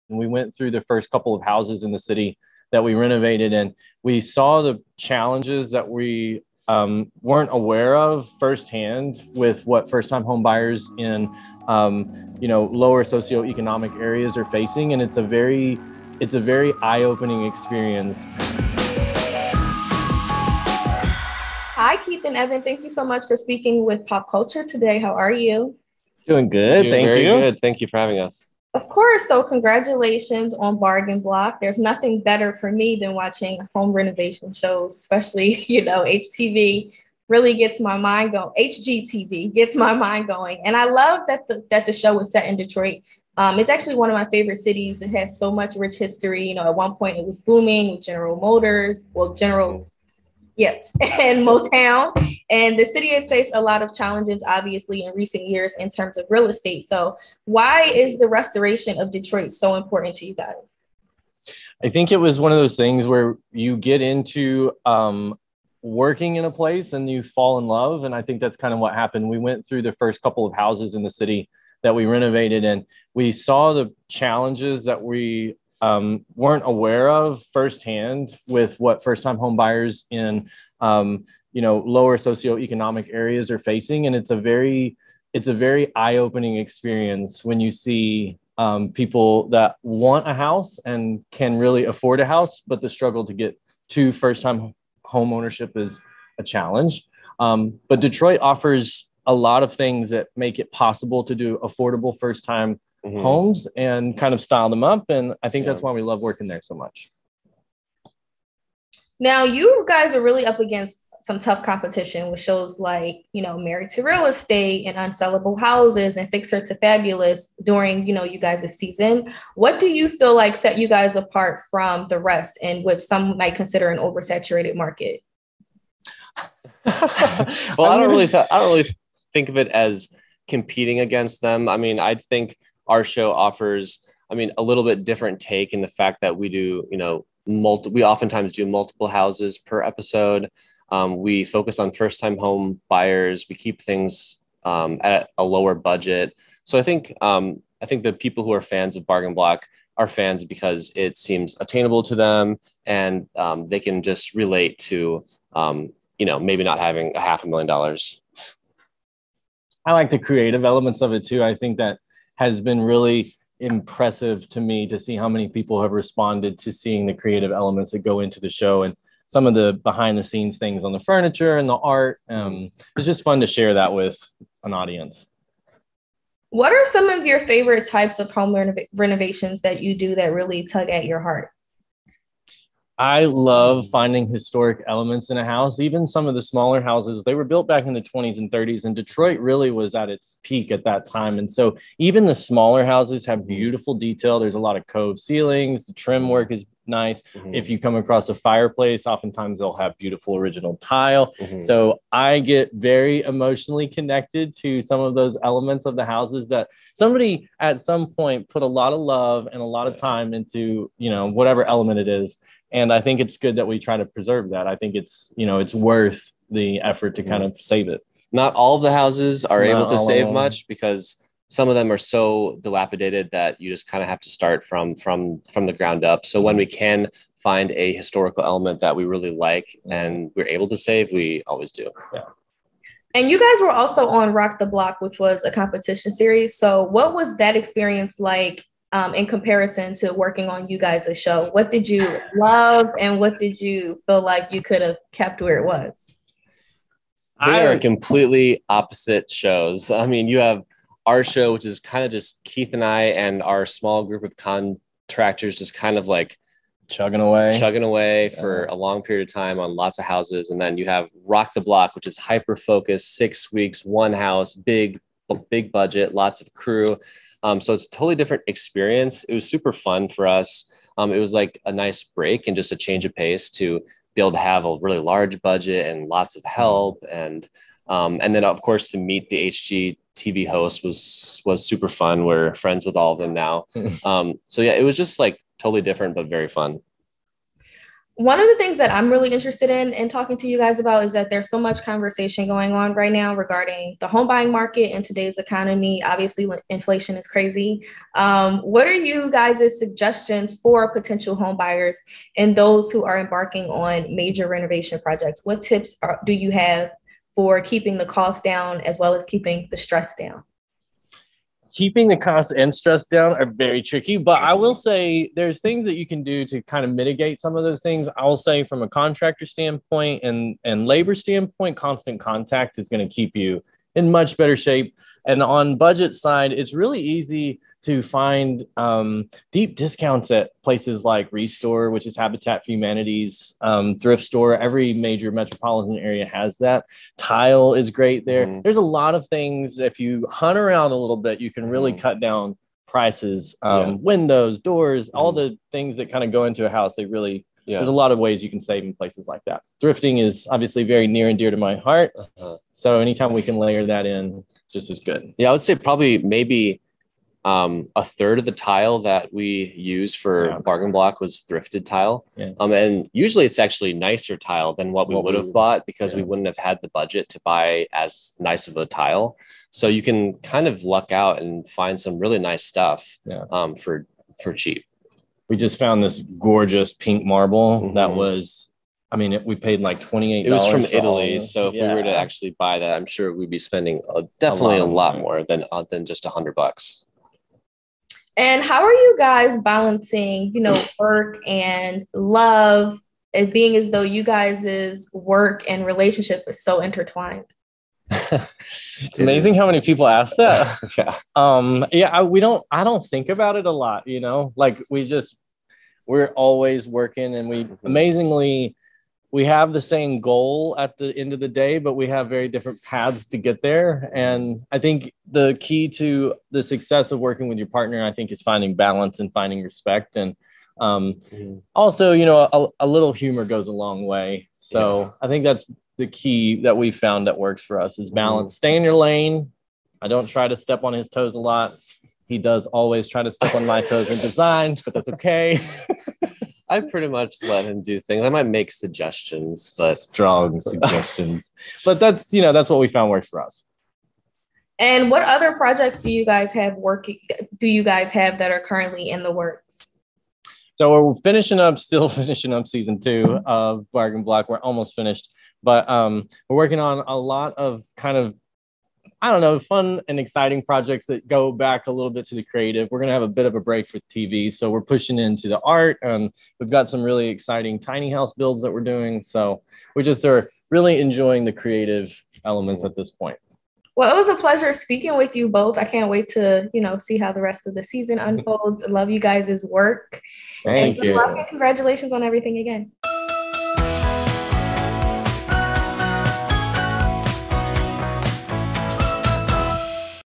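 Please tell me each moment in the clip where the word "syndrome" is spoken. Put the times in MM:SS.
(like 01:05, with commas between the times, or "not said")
not said.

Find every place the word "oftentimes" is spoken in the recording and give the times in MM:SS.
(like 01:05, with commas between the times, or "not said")
02:18, 03:19.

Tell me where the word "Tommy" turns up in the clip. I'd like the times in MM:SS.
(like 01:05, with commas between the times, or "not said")
not said.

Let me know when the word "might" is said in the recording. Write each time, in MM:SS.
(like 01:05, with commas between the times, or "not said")
02:03, 07:18.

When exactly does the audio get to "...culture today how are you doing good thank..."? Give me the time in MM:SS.
00:24.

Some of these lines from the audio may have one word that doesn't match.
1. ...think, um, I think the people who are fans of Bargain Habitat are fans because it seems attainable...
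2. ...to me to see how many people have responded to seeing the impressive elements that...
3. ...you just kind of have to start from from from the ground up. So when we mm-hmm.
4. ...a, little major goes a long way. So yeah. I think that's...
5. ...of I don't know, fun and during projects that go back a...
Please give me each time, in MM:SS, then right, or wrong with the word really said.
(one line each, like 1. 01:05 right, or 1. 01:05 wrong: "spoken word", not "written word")
1. 02:26 wrong: "Block", not "Habitat"
2. 02:44 wrong: "creative", not "impressive"
3. 03:43 right
4. 07:02 wrong: "humor", not "major"
5. 07:38 wrong: "exciting", not "during".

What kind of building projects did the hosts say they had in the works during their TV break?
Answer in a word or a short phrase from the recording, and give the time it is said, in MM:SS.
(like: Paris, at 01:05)
tiny house builds, at 07:47.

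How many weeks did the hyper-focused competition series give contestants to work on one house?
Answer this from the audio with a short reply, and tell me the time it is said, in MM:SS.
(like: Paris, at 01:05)
6, at 04:23.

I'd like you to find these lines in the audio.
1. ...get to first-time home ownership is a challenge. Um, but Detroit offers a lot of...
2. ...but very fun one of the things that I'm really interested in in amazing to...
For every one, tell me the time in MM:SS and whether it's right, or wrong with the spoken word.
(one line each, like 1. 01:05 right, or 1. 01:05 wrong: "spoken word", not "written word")
1. 01:33 right
2. 04:46 wrong: "talking", not "amazing".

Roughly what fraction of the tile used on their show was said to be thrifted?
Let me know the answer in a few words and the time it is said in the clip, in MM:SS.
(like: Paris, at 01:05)
a third, at 05:57.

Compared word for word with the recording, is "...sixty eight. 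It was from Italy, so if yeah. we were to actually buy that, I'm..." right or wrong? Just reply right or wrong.
wrong.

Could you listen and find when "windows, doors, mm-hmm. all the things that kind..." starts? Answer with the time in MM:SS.
05:43.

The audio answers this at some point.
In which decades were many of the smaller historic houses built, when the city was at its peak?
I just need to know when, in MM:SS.
03:08.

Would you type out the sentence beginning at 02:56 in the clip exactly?
What are some of your favorite types of home renov- renovations that you do that really tug at your heart?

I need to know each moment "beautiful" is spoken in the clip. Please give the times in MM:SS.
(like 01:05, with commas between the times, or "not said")
03:13, 03:19.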